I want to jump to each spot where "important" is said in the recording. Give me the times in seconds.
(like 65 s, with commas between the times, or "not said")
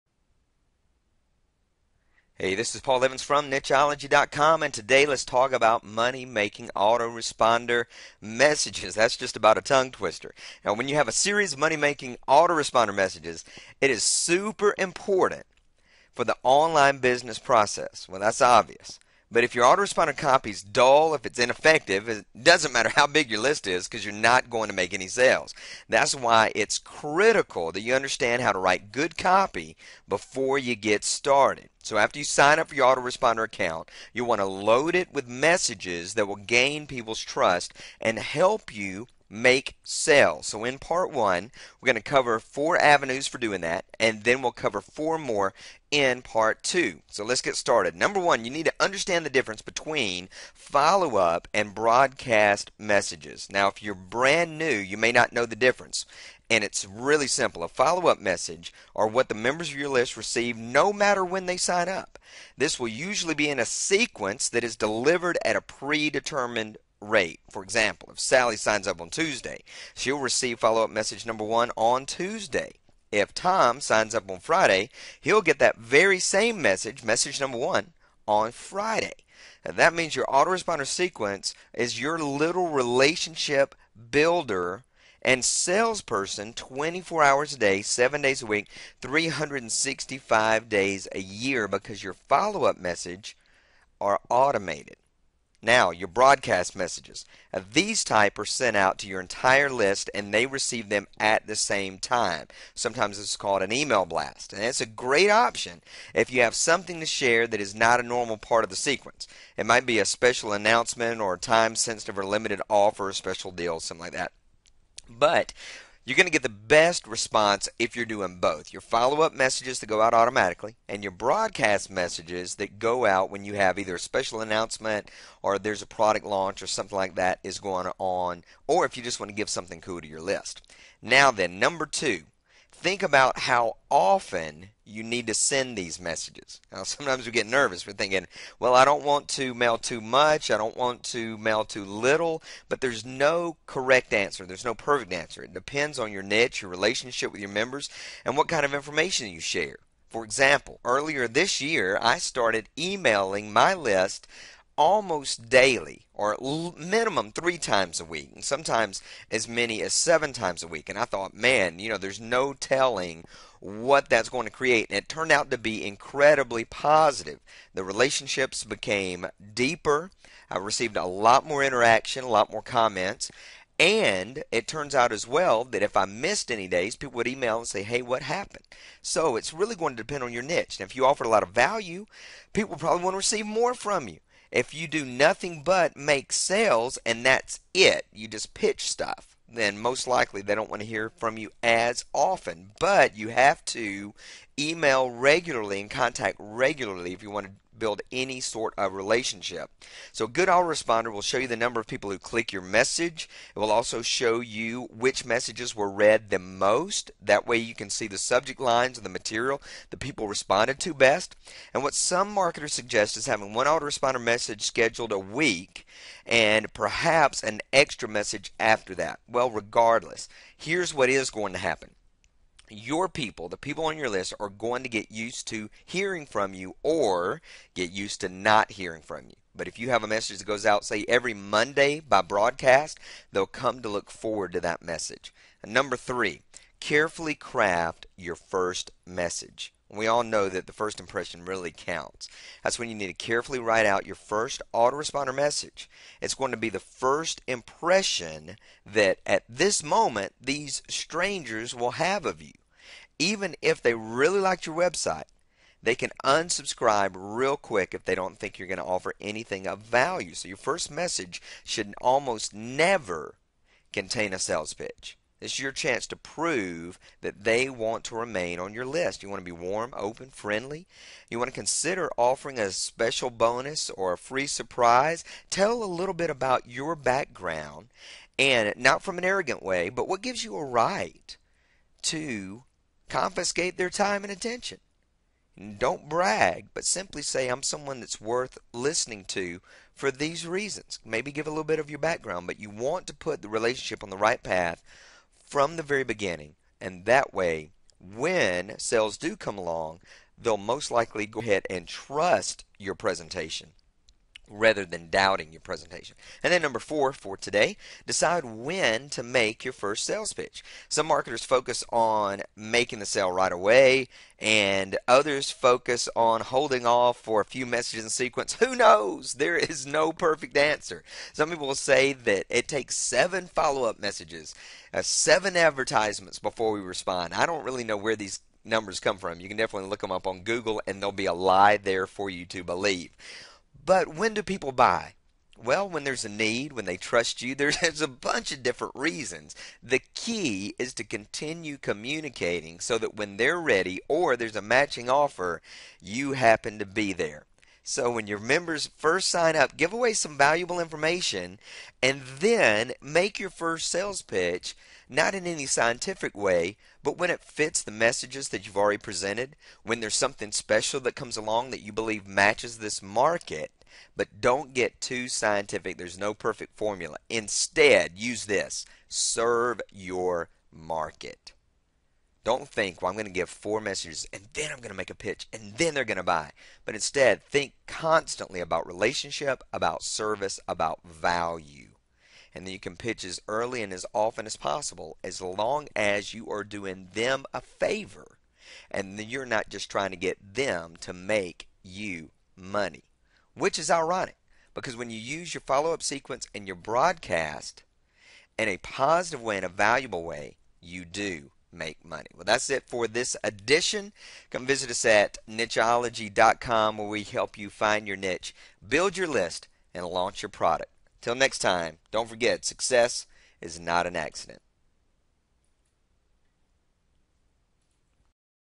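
14 s.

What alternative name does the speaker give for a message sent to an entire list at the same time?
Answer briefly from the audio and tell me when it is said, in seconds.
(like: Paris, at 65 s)
Email blast, at 103 s.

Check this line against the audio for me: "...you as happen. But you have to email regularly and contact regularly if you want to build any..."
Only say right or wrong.
wrong.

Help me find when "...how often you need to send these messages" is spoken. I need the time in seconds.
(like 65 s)
133 s.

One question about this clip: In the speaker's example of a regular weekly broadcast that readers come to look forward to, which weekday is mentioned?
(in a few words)
Monday.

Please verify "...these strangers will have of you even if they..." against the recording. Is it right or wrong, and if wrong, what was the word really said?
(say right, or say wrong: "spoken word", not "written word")
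right.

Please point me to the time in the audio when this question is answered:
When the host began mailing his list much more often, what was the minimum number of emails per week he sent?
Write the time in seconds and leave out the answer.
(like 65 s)
157 s.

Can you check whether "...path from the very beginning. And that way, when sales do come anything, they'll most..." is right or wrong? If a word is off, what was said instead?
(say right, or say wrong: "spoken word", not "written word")
wrong: "along", not "anything".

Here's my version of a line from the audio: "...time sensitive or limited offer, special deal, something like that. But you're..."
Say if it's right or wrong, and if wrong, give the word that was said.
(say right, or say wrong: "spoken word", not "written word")
right.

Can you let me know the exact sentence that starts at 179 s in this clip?
So it's really going to depend on your niche.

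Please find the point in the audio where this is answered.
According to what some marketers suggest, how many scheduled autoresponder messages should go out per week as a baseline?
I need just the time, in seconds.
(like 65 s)
213 s.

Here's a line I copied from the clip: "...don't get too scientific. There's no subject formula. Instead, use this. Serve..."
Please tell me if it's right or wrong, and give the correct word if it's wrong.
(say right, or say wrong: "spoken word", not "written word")
wrong: "perfect", not "subject".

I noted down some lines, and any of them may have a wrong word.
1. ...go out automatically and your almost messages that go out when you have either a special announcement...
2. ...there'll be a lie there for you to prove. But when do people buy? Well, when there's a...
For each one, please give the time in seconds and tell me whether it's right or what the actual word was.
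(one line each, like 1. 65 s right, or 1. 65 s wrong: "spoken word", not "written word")
1. 119 s wrong: "broadcast", not "almost"
2. 331 s wrong: "believe", not "prove".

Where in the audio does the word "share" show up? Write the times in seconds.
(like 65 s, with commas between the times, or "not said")
107 s, 149 s.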